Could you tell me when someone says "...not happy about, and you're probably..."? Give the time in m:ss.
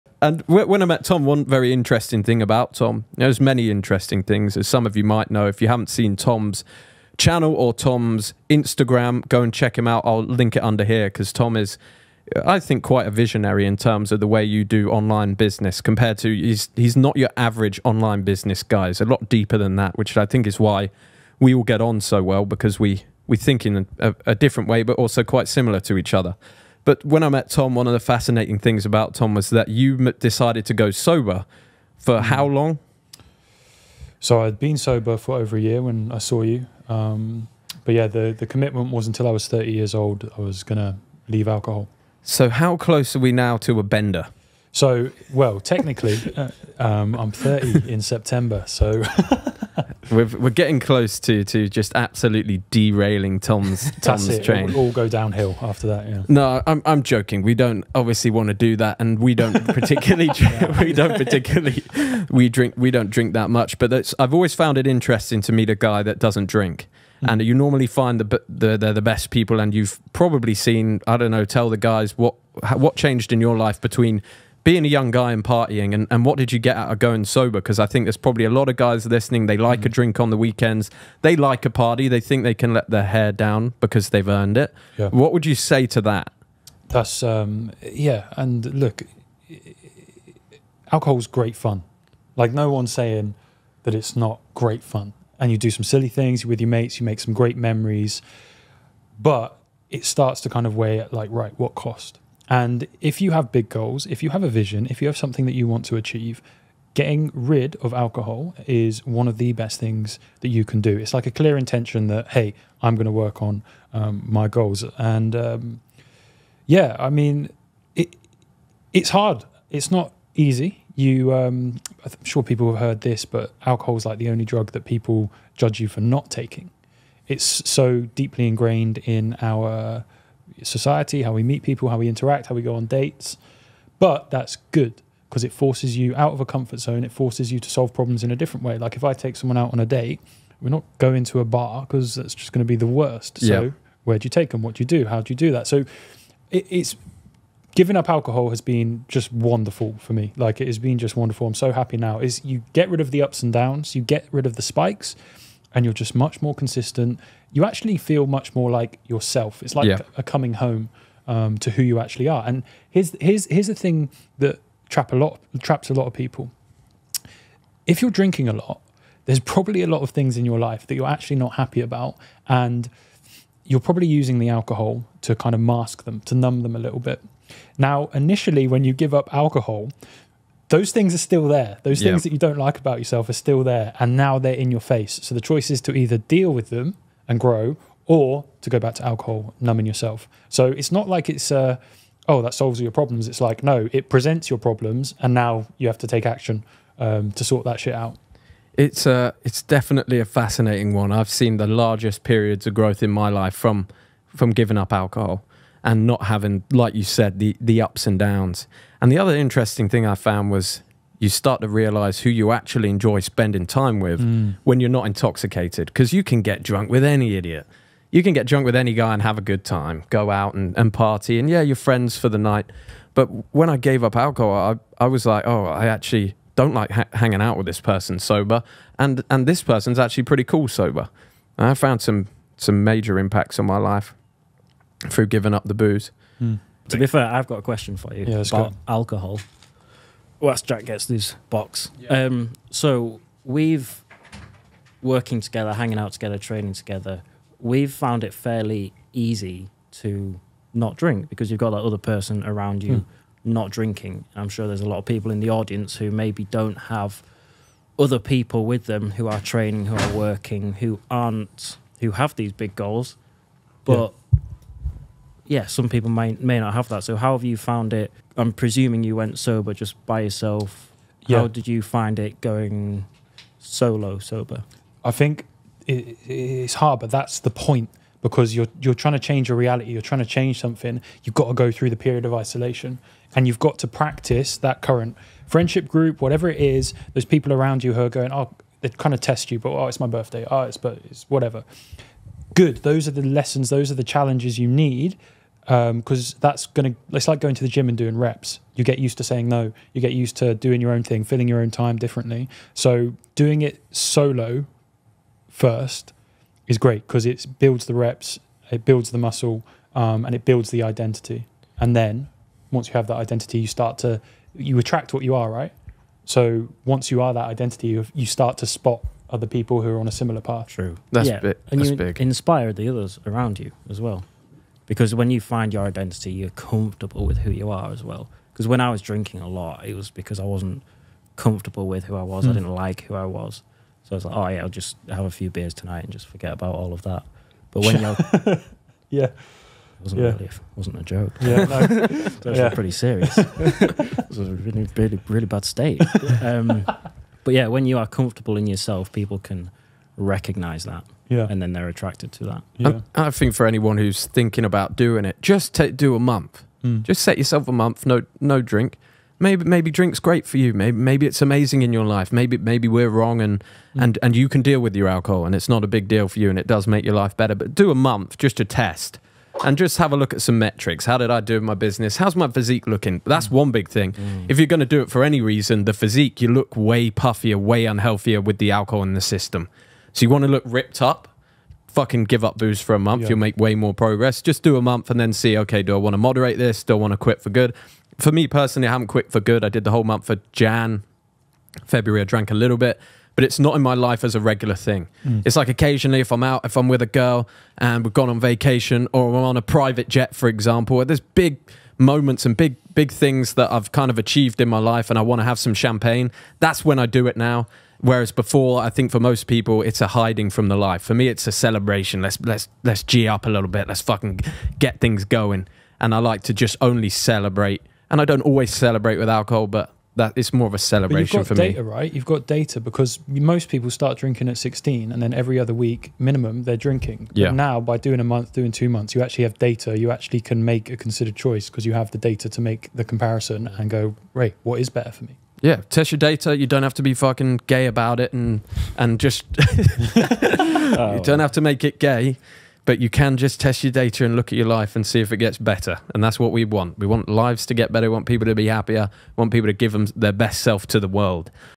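2:51.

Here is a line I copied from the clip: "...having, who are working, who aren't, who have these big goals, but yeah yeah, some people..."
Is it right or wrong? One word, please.
wrong.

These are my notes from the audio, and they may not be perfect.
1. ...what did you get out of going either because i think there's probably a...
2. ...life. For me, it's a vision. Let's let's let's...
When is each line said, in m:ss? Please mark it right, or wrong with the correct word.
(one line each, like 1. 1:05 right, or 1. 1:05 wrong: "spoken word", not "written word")
1. 1:16 wrong: "sober", not "either"
2. 6:50 wrong: "celebration", not "vision".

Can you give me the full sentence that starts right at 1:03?
But I've always found it interesting to meet a guy that doesn't drink hmm.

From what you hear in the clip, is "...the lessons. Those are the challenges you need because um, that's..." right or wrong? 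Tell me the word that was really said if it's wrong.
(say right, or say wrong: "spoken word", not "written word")
right.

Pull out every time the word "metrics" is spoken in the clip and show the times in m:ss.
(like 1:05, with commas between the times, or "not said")
6:10.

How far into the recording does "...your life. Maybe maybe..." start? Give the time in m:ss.
6:01.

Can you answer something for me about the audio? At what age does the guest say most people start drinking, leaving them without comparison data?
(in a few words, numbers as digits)
16.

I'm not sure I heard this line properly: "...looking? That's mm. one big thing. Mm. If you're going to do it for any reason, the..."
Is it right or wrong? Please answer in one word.
right.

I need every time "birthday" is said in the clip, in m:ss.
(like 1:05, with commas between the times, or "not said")
4:50.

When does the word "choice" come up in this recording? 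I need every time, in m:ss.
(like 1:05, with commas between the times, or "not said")
3:05, 7:11.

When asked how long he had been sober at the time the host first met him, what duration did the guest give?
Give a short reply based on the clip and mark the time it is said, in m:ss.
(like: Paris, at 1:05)
Over a year, at 0:35.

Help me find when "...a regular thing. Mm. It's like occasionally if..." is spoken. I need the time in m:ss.
6:34.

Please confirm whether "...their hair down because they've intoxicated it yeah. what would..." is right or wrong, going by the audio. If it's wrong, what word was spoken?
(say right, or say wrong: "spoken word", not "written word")
wrong: "earned", not "intoxicated".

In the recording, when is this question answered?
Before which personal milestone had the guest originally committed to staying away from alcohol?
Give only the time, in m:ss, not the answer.
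0:39.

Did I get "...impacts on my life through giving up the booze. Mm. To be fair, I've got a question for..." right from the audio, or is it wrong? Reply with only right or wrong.
right.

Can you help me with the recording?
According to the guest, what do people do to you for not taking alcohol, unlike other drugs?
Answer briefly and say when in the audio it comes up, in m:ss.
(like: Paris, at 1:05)
Judge you, at 2:05.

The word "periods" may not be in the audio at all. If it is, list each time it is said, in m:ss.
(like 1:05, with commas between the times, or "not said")
3:22, 4:42.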